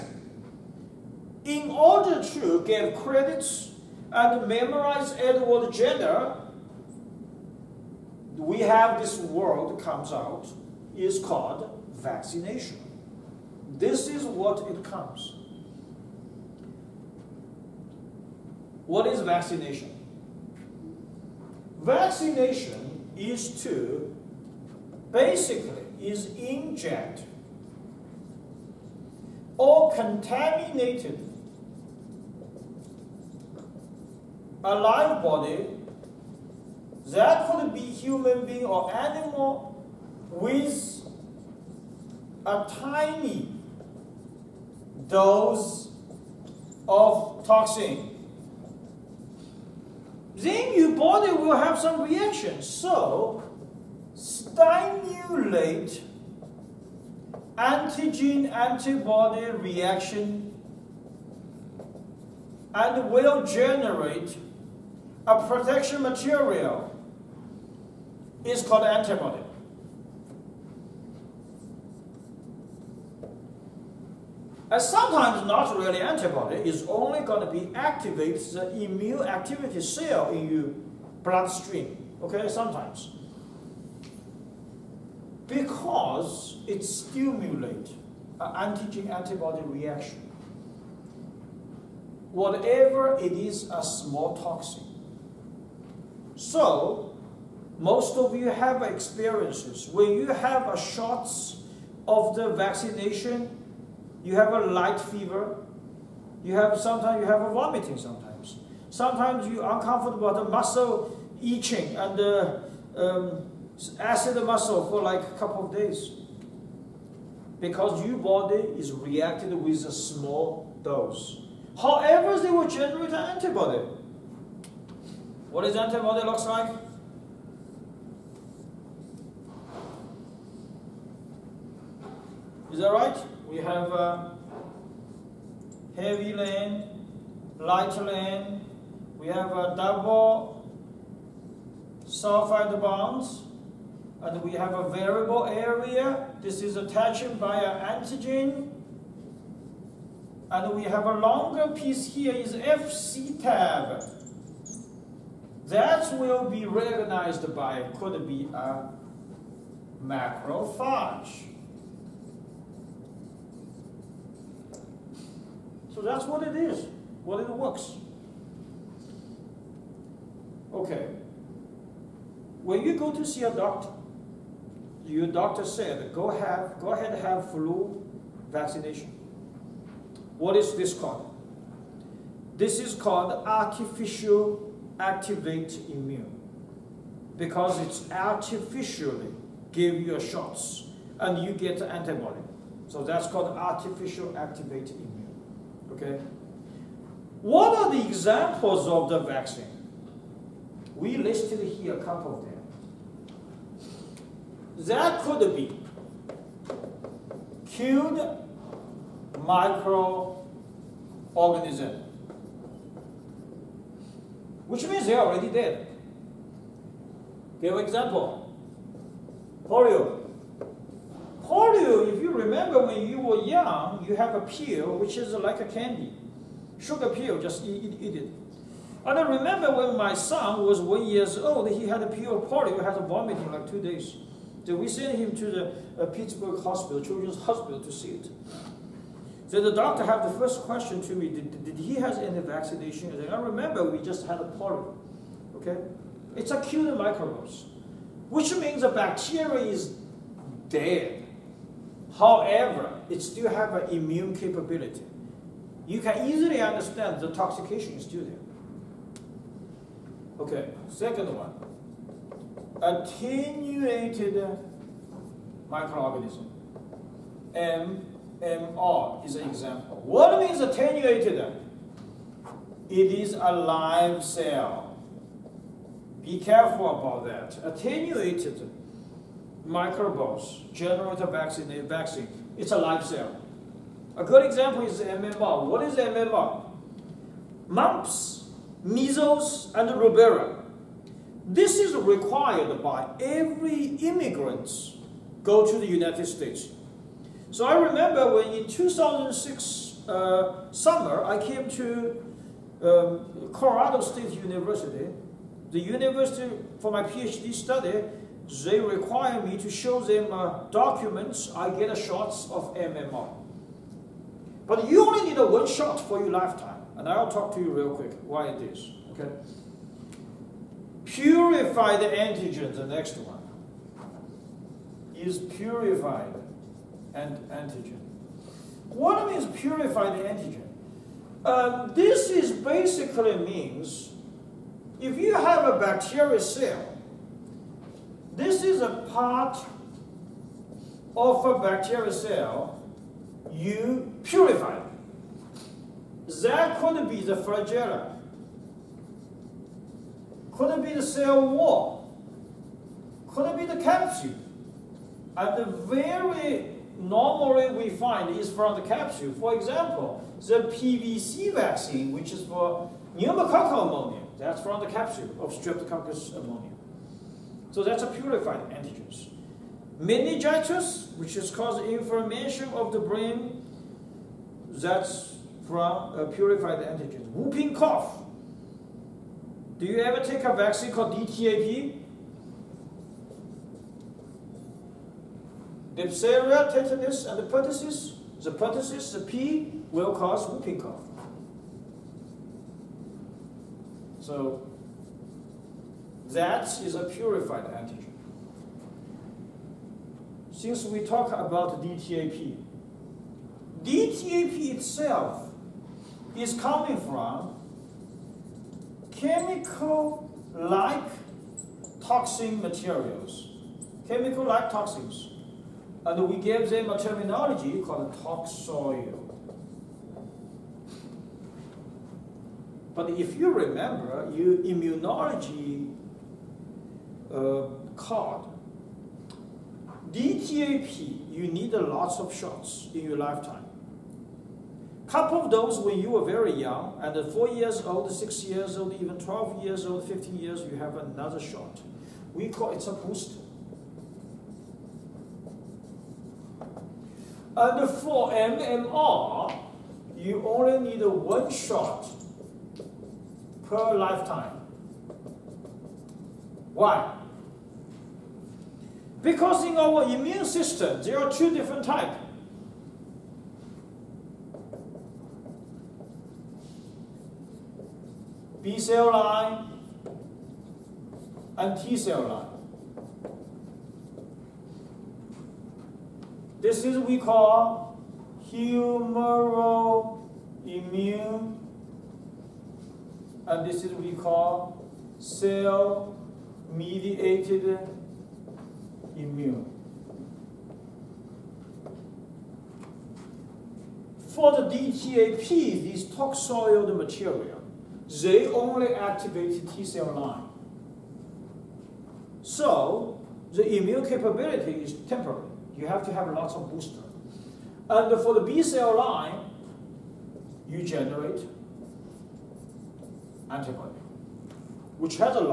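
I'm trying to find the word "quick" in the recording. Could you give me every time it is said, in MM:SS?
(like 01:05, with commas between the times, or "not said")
05:17.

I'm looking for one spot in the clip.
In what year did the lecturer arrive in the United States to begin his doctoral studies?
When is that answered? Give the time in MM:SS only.
04:58.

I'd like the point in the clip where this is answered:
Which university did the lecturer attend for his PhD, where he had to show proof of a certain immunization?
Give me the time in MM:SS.
05:03.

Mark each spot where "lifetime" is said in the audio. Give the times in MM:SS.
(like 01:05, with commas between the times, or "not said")
05:16, 07:13, 07:33.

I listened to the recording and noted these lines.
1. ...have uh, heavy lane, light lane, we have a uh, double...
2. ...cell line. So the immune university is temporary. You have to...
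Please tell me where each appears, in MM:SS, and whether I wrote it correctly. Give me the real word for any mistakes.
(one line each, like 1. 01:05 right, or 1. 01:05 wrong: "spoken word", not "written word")
1. 02:13 right
2. 08:19 wrong: "capability", not "university".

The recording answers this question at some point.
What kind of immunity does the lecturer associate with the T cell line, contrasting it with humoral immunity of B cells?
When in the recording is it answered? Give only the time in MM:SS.
08:05.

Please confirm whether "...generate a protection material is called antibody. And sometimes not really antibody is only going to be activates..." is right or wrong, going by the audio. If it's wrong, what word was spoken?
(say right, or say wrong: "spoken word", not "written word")
right.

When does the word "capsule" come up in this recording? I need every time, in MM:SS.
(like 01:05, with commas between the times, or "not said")
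05:53, 05:58, 06:04.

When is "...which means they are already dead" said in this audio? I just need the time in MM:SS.
03:34.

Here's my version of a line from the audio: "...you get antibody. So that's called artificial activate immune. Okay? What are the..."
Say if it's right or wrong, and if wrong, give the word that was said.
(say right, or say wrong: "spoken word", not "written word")
right.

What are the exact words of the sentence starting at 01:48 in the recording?
Sometimes you uncomfortable, the muscle itching and the um, acid muscle for like a couple of days.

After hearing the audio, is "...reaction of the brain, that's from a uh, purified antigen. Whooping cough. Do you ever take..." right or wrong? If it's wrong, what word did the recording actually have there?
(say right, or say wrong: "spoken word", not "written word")
wrong: "inflammation", not "reaction".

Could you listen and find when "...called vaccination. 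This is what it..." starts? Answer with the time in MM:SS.
00:11.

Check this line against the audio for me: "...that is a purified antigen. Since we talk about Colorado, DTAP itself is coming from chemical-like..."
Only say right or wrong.
wrong.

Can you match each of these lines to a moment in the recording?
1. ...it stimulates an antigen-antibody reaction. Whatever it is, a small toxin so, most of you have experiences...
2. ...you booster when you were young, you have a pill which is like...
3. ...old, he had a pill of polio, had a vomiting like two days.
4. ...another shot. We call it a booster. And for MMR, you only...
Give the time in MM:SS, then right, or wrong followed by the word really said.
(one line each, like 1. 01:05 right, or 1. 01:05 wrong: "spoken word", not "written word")
1. 01:26 right
2. 03:42 wrong: "remember", not "booster"
3. 03:51 right
4. 07:20 right.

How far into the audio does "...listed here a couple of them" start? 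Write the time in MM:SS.
03:21.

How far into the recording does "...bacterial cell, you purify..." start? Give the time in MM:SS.
05:41.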